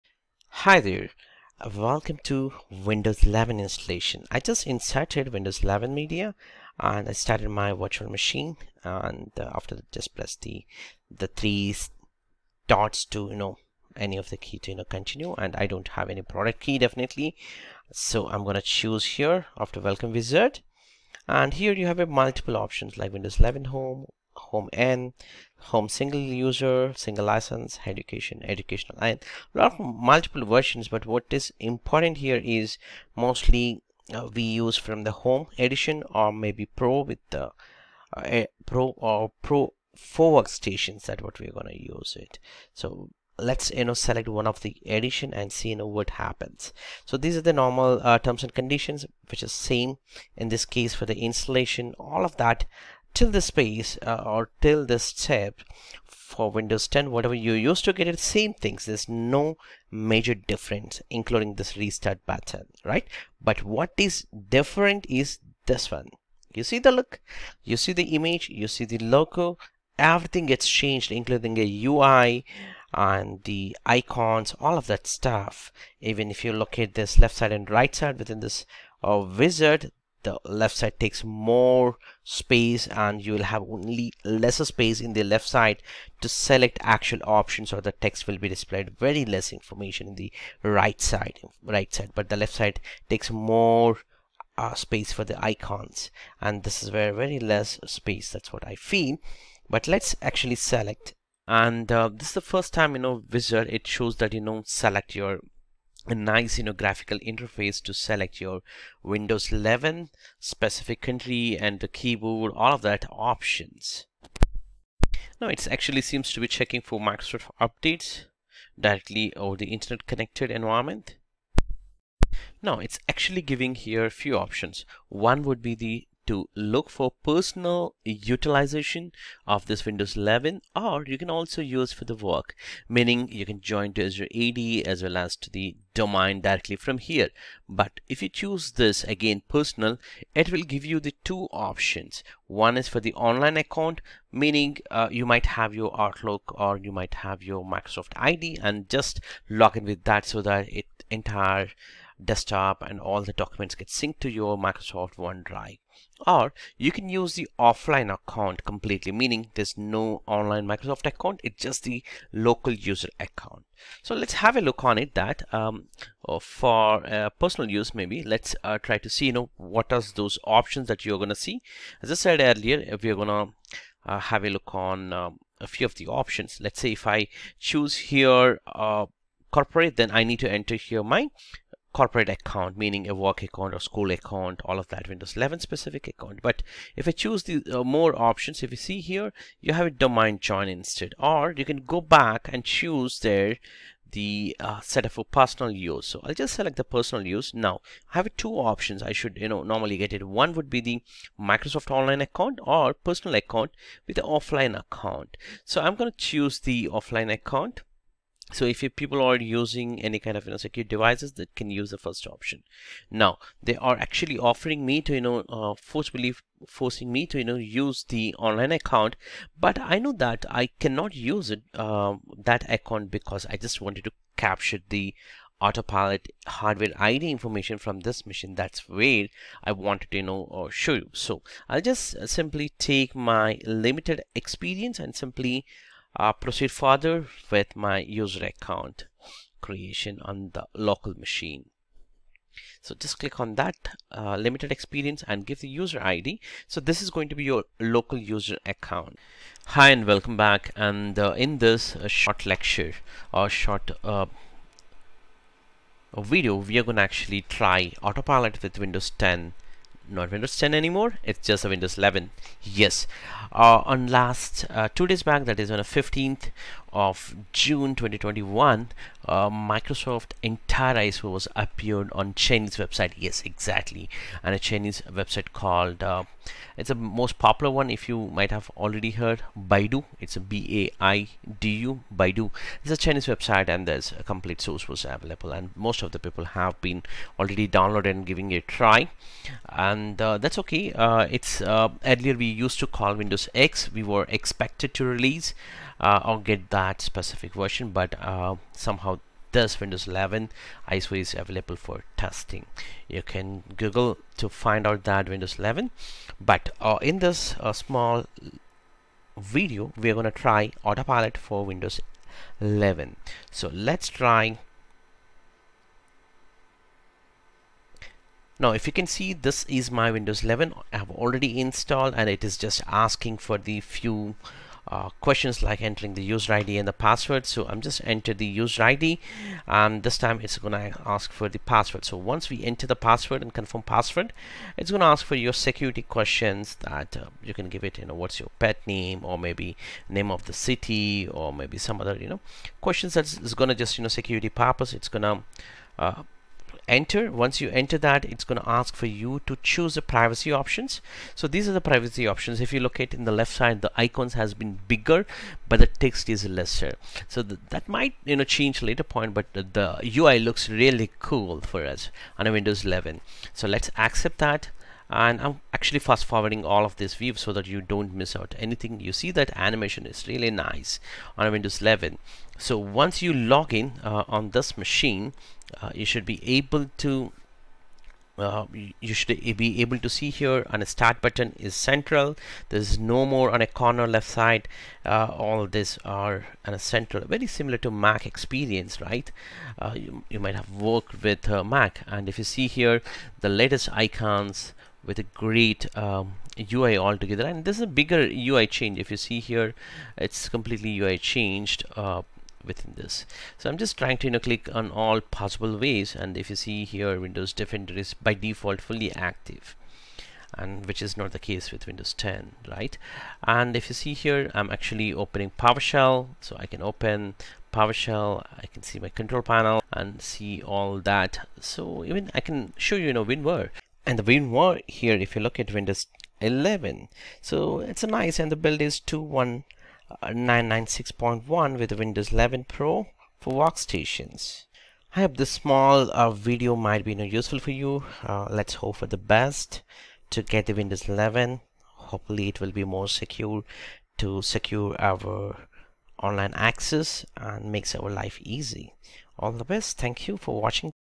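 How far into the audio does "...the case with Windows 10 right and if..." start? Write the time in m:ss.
6:51.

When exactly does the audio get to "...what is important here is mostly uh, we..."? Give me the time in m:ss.
0:31.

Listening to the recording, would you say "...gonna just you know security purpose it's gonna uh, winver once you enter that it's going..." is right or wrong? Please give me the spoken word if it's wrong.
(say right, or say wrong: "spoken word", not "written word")
wrong: "enter", not "winver".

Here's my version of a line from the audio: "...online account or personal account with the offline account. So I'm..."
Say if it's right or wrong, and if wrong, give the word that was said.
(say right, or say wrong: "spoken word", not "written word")
right.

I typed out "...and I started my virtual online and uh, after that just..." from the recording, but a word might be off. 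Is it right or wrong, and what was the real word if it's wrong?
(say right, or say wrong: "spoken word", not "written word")
wrong: "machine", not "online".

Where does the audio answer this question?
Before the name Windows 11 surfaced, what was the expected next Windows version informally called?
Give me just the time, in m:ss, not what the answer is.
4:53.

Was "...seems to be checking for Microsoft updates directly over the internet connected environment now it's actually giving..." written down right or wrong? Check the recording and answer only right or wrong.
right.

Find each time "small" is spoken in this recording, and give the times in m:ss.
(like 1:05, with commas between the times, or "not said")
5:07, 7:15.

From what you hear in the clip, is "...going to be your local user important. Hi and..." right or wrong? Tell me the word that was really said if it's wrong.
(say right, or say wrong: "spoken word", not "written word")
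wrong: "account", not "important".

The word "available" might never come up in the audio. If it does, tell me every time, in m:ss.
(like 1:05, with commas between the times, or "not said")
4:45, 5:01.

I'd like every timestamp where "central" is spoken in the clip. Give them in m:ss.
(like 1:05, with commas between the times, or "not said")
6:21, 6:26.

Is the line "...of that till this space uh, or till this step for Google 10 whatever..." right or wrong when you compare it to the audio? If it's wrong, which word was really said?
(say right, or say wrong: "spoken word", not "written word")
wrong: "Windows", not "Google".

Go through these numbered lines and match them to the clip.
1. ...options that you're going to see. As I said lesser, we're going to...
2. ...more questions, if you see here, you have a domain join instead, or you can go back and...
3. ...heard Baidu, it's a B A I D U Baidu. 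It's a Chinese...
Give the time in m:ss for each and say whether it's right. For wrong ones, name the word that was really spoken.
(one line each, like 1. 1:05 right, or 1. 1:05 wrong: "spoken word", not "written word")
1. 2:50 wrong: "earlier", not "lesser"
2. 3:07 wrong: "options", not "questions"
3. 4:39 right.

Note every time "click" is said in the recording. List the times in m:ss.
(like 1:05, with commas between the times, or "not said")
4:03, 6:44.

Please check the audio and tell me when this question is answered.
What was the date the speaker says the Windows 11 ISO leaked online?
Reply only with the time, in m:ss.
4:25.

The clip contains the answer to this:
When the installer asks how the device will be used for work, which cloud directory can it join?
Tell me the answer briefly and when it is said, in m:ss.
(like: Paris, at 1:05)
Azure AD, at 2:14.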